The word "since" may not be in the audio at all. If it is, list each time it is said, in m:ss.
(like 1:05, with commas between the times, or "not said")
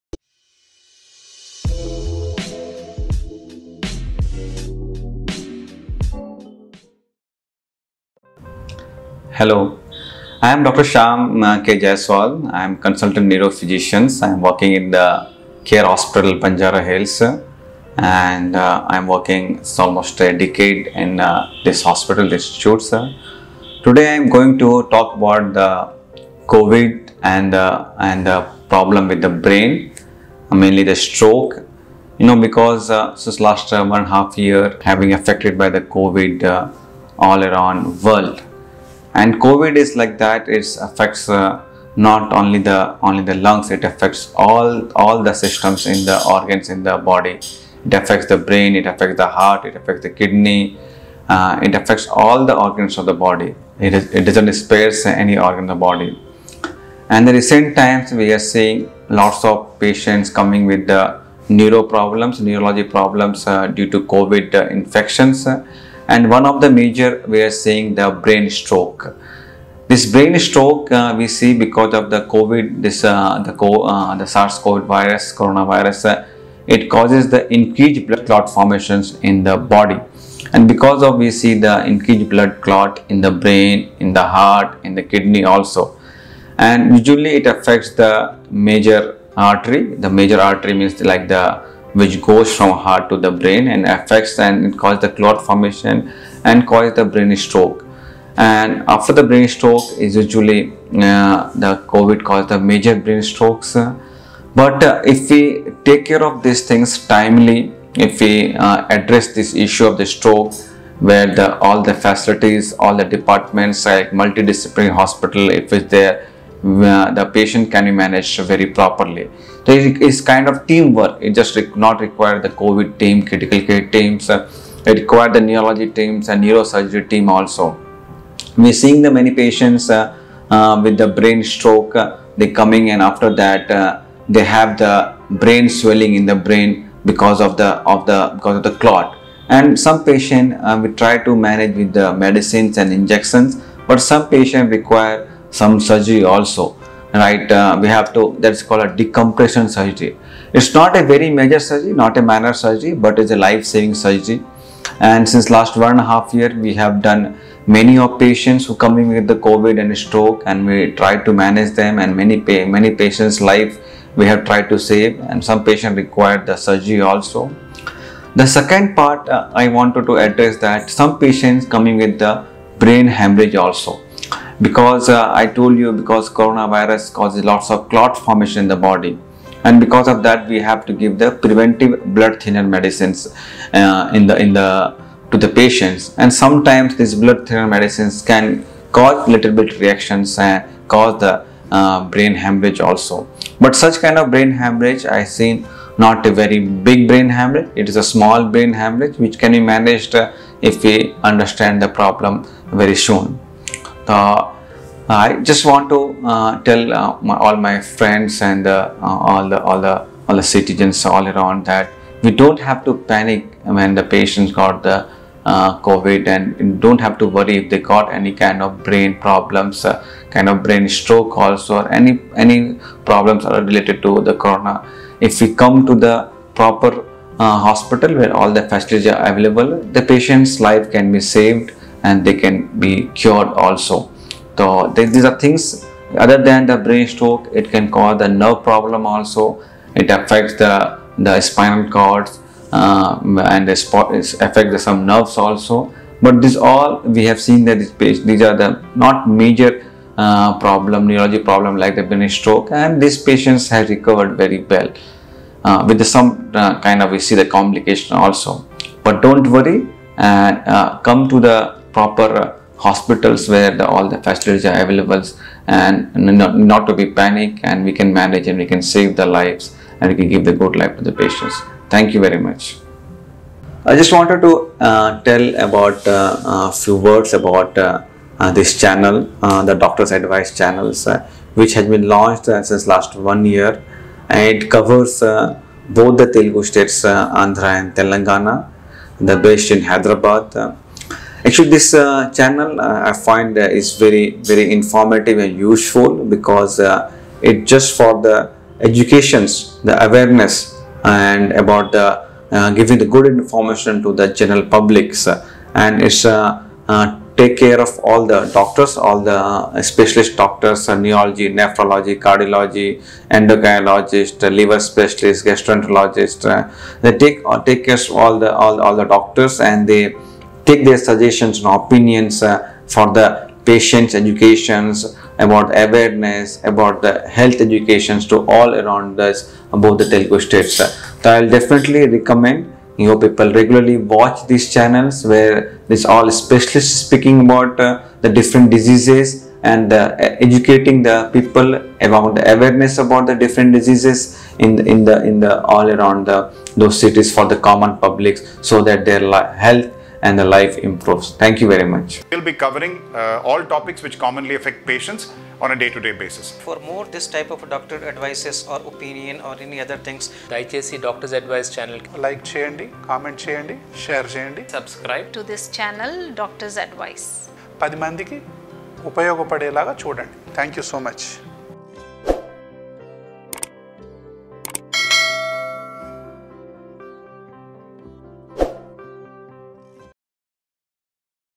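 0:33, 2:35, 4:42.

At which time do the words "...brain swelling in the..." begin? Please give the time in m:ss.
2:15.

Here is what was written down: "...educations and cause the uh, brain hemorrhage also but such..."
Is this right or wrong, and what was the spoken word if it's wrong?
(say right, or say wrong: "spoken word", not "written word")
wrong: "reactions", not "educations".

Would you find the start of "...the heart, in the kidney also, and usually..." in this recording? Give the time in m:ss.
1:24.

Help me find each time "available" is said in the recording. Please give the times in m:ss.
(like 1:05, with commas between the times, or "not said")
3:49, 4:24.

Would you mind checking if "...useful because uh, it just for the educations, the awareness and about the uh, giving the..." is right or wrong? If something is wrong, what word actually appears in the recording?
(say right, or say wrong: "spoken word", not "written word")
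right.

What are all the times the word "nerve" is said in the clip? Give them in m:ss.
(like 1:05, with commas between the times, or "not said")
3:58, 4:05.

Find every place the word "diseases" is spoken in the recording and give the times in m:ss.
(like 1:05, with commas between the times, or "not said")
5:38, 5:43.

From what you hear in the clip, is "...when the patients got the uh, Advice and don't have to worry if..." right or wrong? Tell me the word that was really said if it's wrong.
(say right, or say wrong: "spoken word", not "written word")
wrong: "COVID", not "Advice".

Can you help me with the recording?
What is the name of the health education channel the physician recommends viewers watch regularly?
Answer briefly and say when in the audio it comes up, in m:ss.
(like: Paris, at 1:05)
Doctor's Advice, at 4:39.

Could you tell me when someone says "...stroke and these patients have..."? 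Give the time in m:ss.
4:12.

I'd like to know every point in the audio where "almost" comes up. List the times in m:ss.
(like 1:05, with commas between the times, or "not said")
0:19.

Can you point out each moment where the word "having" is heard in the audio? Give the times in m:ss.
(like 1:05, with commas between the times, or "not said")
0:34.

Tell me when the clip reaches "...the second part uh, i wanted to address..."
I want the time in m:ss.
2:48.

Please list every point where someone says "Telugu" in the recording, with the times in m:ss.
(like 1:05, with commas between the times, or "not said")
4:46, 5:30.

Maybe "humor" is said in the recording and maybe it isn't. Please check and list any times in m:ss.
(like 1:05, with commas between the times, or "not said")
not said.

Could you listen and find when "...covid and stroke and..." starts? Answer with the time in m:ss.
2:39.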